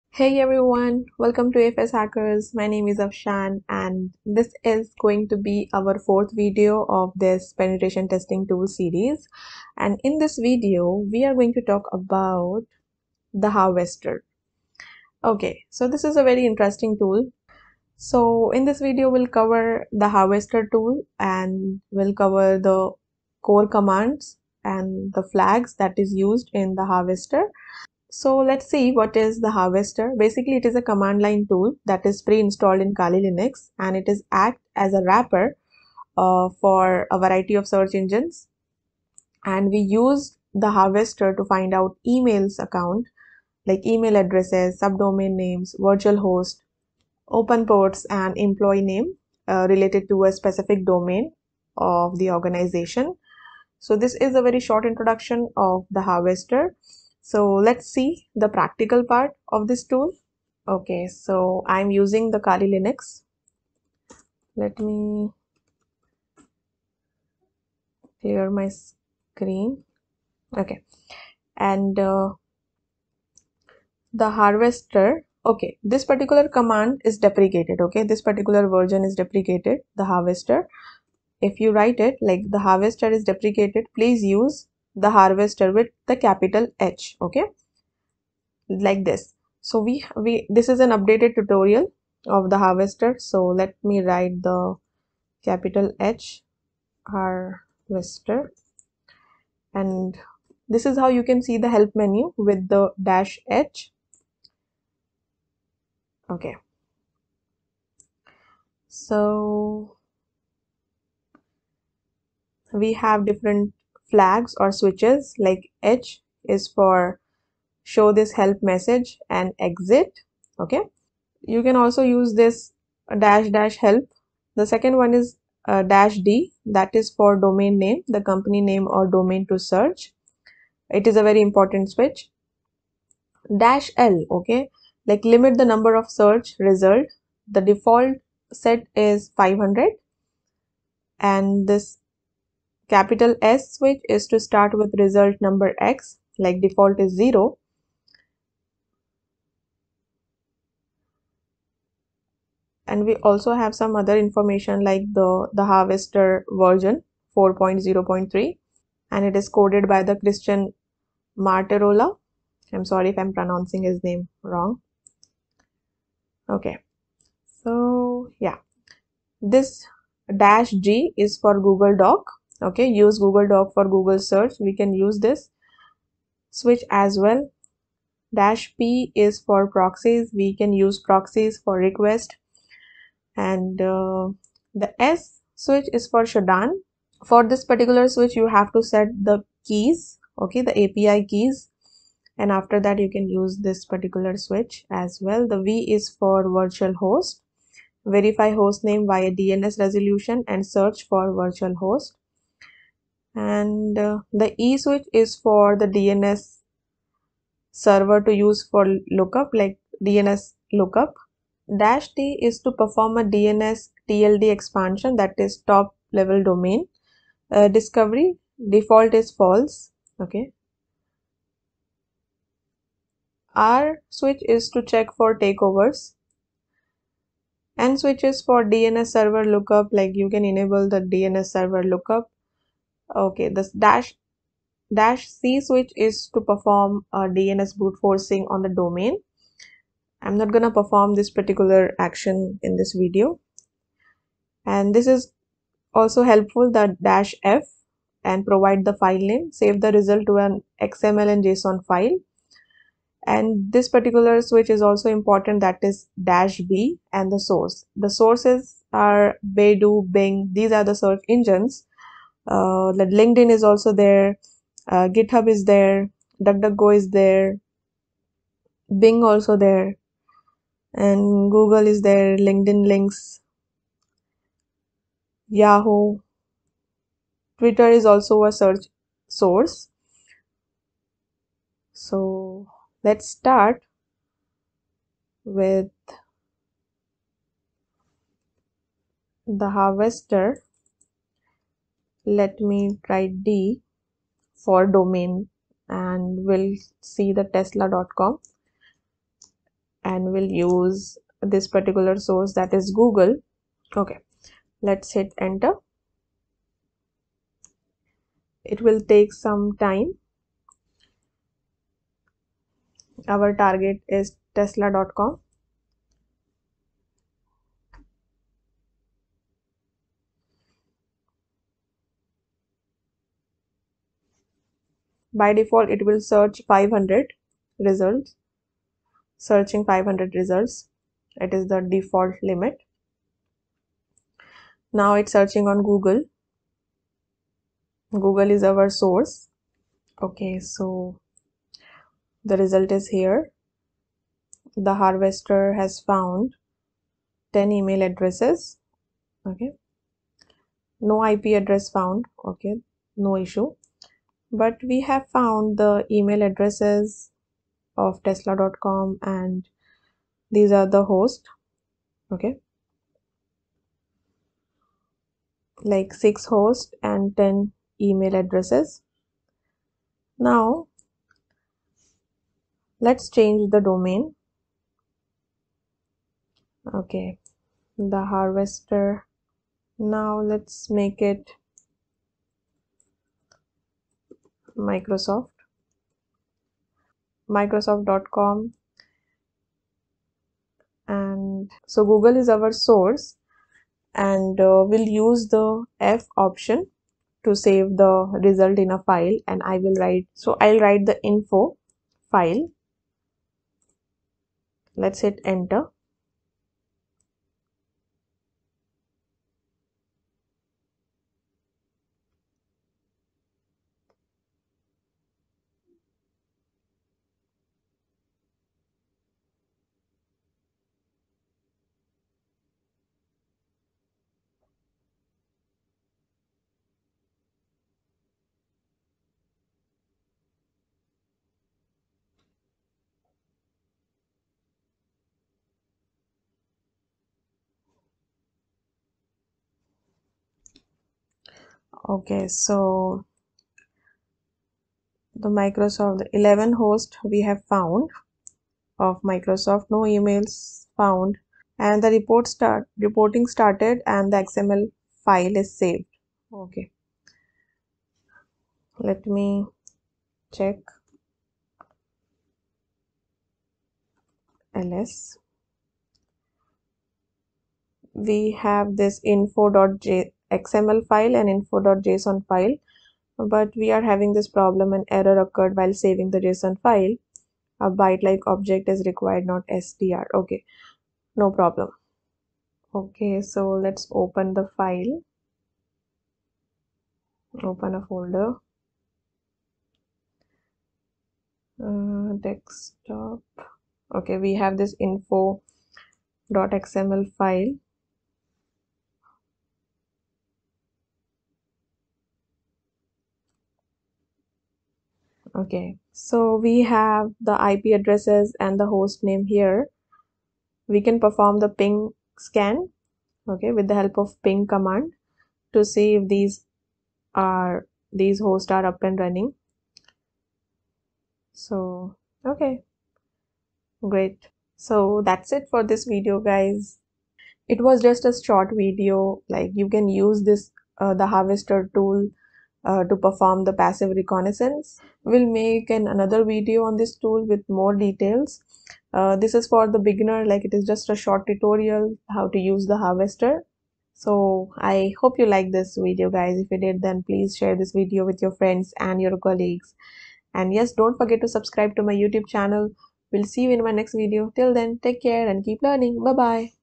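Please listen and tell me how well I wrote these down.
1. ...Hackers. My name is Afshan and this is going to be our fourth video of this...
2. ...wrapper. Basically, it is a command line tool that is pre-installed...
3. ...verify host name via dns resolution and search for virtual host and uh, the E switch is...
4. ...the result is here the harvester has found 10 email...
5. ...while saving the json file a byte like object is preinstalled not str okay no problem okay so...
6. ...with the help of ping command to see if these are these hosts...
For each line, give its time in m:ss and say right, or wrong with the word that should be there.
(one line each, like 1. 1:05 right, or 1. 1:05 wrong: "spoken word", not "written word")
1. 0:01 right
2. 0:29 wrong: "harvester", not "wrapper"
3. 3:18 right
4. 5:42 right
5. 7:55 wrong: "required", not "preinstalled"
6. 8:33 right.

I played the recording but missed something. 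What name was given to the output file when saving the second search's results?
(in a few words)
info.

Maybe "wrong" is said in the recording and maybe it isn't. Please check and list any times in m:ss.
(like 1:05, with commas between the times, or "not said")
2:44.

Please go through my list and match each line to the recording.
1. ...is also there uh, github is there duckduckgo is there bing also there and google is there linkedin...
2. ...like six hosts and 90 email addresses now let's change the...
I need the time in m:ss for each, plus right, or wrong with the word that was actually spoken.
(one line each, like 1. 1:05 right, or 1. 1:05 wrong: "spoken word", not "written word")
1. 4:23 right
2. 6:05 wrong: "10", not "90".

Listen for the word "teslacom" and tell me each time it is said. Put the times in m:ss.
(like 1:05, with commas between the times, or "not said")
4:57, 5:14, 5:58.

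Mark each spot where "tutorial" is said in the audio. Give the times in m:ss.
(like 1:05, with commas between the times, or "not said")
1:31, 9:01.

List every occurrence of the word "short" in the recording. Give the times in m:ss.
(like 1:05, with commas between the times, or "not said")
0:54, 8:48, 9:01.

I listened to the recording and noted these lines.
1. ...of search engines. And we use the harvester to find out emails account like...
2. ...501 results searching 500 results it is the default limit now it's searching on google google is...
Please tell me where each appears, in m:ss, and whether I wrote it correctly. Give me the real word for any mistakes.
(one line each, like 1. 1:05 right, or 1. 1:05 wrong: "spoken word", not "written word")
1. 0:37 right
2. 5:26 wrong: "500", not "501".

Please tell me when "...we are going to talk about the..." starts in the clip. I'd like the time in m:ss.
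0:11.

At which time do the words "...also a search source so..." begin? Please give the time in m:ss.
4:38.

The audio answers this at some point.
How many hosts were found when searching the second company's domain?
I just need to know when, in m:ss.
7:26.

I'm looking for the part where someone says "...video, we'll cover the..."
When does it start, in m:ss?
0:18.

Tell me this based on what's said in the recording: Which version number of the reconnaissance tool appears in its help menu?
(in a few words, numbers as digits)
4.0.3.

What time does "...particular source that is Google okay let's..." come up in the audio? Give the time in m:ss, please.
5:01.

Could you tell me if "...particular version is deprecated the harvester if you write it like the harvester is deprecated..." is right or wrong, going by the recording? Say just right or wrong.
right.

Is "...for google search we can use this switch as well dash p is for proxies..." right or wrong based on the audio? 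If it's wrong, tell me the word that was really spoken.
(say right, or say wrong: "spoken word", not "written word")
right.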